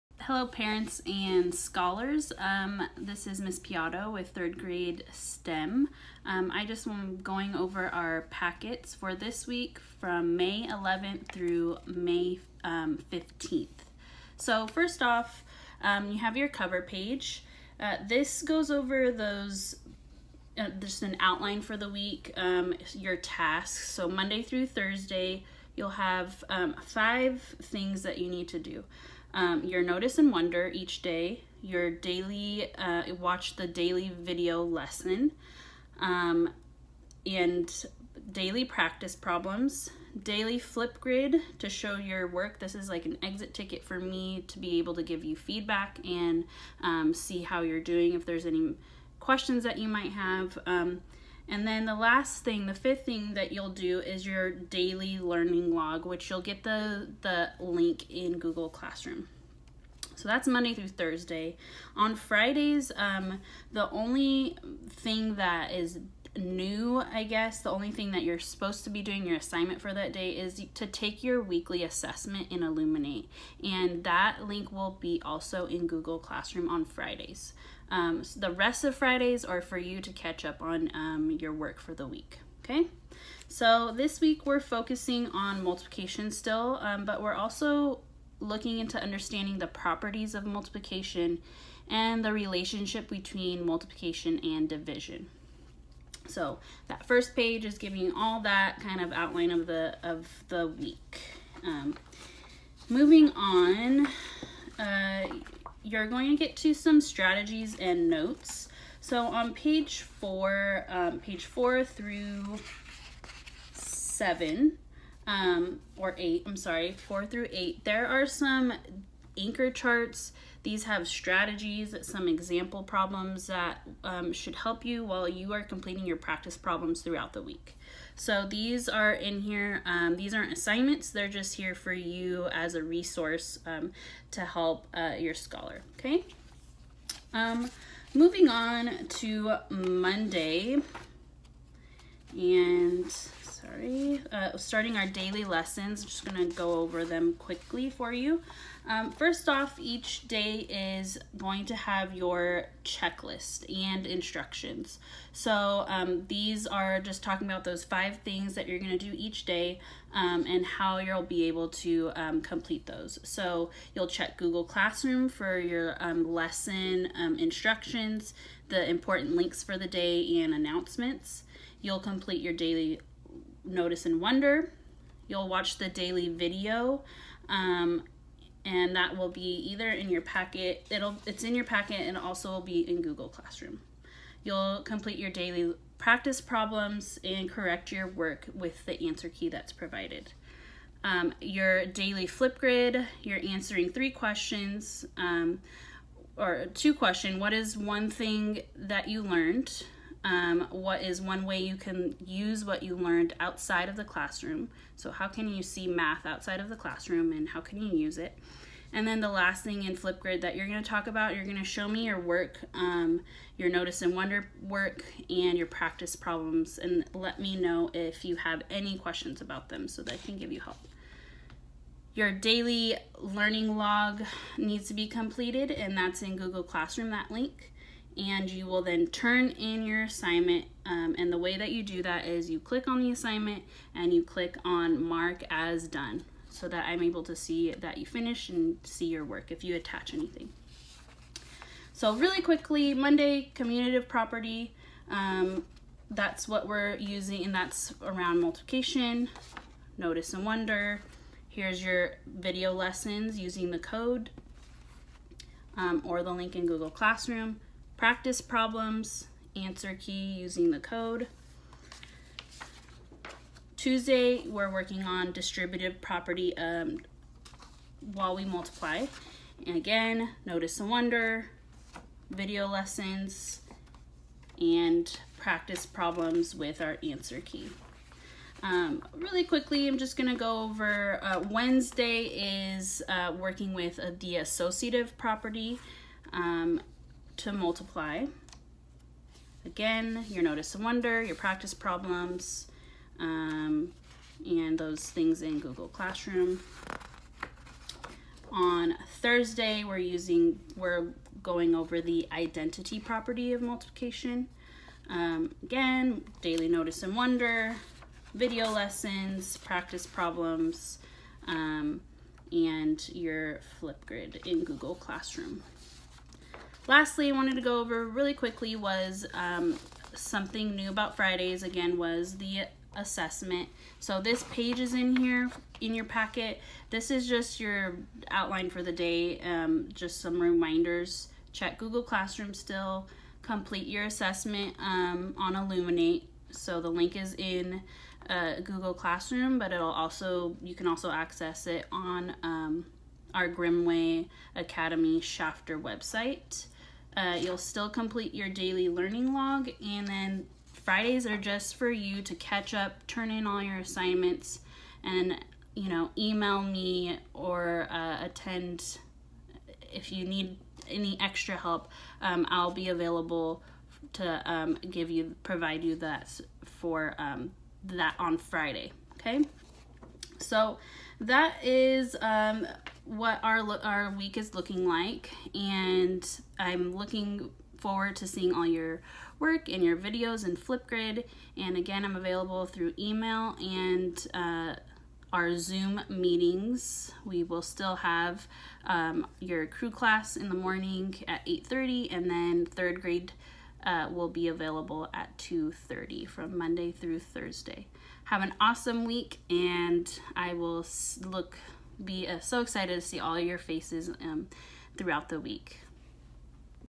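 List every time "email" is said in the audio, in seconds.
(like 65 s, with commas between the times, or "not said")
356 s, 382 s.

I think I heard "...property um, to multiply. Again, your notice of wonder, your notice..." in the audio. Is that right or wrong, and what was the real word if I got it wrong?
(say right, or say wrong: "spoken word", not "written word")
wrong: "practice", not "notice".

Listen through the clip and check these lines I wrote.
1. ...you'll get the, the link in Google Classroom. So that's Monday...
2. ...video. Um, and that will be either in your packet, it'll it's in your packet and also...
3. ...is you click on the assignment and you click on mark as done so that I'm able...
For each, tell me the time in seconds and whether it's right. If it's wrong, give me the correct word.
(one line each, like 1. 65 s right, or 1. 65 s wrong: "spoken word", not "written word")
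1. 56 s right
2. 176 s right
3. 232 s right.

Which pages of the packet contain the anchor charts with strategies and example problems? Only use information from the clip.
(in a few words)
4 through 8.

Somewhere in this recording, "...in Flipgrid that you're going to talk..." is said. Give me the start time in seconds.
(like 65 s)
209 s.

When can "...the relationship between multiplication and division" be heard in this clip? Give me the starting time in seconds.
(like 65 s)
92 s.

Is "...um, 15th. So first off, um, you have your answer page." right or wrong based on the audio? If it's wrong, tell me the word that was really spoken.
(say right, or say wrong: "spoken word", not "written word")
wrong: "cover", not "answer".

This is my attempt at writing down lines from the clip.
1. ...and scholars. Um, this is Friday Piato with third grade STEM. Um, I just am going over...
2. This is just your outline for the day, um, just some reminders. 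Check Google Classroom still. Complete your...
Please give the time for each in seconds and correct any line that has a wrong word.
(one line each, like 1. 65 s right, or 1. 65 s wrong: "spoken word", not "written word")
1. 1 s wrong: "Miss", not "Friday"
2. 326 s right.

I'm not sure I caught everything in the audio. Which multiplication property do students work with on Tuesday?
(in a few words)
Distributive property.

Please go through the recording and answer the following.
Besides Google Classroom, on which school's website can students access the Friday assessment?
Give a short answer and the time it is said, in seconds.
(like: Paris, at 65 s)
Grimmway Academy Shafter, at 343 s.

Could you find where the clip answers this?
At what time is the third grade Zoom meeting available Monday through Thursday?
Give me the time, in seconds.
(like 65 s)
395 s.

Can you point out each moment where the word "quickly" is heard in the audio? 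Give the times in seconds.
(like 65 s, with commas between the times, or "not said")
147 s, 242 s, 279 s, 318 s.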